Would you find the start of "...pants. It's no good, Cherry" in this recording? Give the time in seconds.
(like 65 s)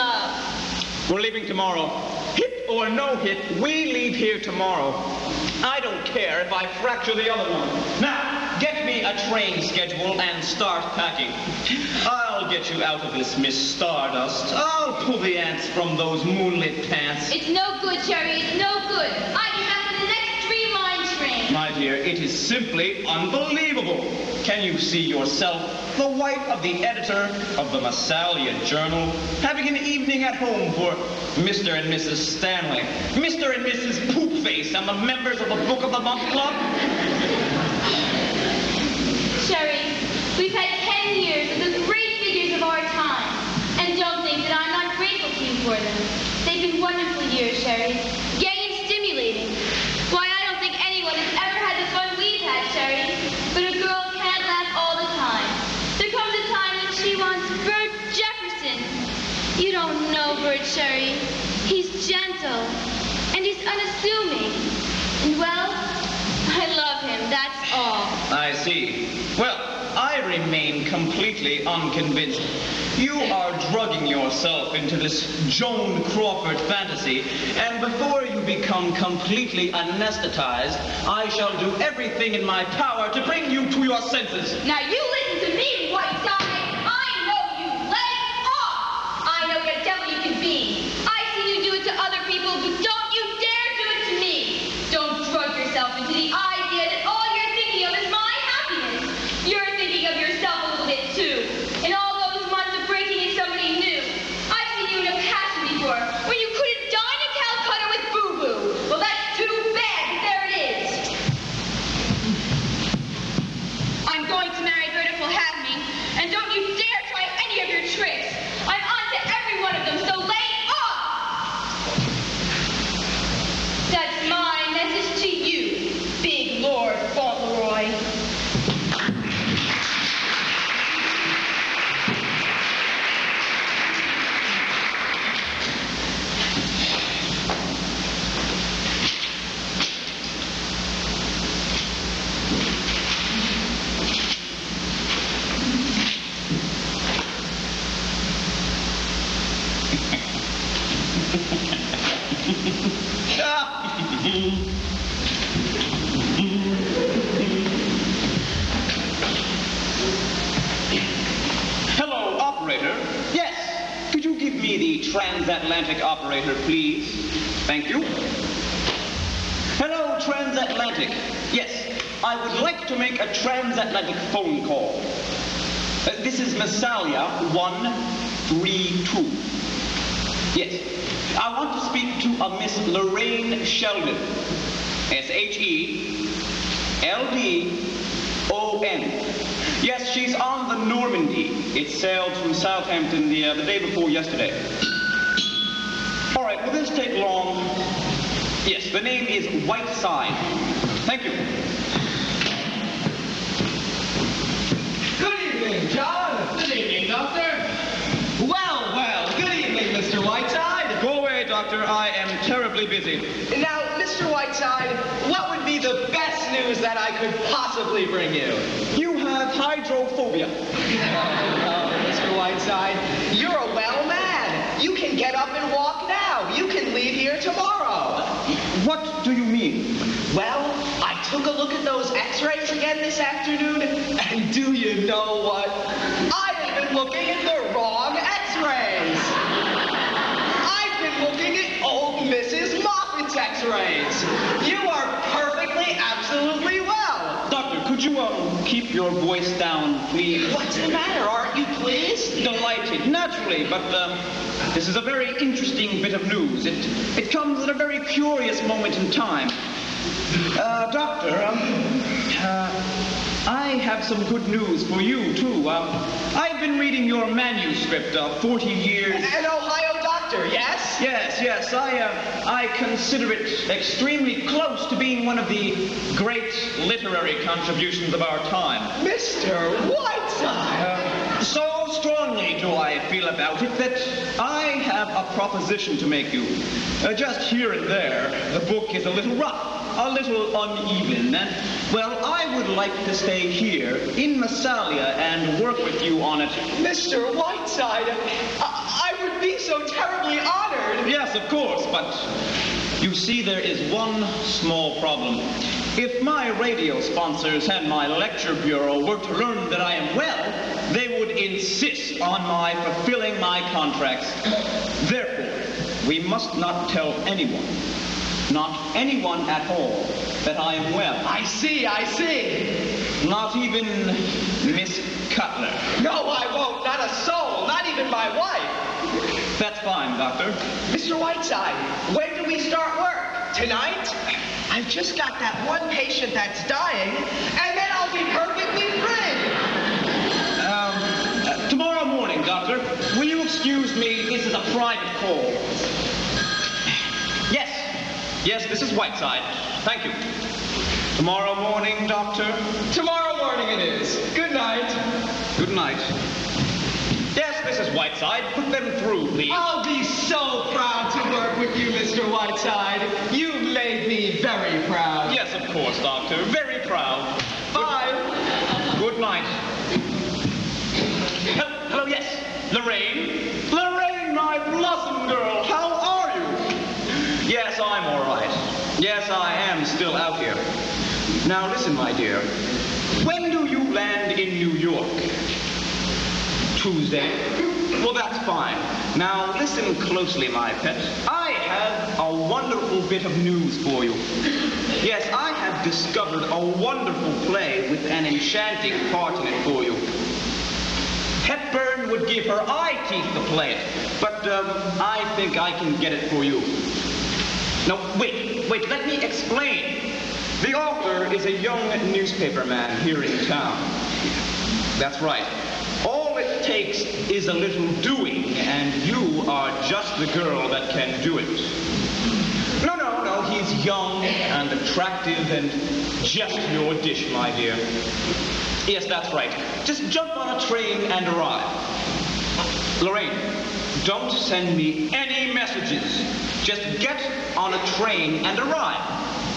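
16 s.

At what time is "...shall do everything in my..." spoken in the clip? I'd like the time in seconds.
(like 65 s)
81 s.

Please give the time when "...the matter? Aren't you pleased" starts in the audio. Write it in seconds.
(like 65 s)
250 s.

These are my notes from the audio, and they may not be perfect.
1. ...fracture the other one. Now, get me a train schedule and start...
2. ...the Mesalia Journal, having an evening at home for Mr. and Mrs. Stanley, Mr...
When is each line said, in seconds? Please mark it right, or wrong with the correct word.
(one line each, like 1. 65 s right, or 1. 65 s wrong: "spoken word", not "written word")
1. 6 s right
2. 27 s right.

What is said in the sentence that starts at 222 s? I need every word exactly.
Whiteside, you're a you can get up and walk now.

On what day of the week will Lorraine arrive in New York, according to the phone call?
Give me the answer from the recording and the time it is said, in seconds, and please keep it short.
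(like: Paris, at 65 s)
Tuesday, at 386 s.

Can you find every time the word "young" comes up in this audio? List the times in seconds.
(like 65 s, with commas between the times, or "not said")
411 s, 423 s.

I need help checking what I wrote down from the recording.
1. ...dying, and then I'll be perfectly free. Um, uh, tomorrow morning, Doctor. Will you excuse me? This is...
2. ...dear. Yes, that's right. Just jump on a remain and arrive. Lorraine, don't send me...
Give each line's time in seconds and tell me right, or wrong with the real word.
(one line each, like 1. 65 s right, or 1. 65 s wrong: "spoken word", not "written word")
1. 336 s right
2. 427 s wrong: "train", not "remain".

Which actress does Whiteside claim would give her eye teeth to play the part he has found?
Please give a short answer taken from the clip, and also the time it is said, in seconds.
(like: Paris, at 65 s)
Hepburn, at 401 s.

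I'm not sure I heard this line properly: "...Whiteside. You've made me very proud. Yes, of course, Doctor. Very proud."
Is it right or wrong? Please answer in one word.
right.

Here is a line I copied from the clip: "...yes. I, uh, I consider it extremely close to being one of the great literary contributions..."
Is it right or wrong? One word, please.
right.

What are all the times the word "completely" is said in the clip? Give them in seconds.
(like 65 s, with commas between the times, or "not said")
70 s, 78 s.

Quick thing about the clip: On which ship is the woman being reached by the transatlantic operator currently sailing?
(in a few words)
Normandy.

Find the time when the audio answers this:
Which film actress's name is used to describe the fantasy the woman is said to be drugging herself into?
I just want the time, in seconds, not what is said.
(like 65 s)
75 s.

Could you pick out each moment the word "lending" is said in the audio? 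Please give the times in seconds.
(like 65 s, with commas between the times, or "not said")
not said.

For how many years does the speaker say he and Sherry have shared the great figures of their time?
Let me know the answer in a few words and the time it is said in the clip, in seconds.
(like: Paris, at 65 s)
10, at 41 s.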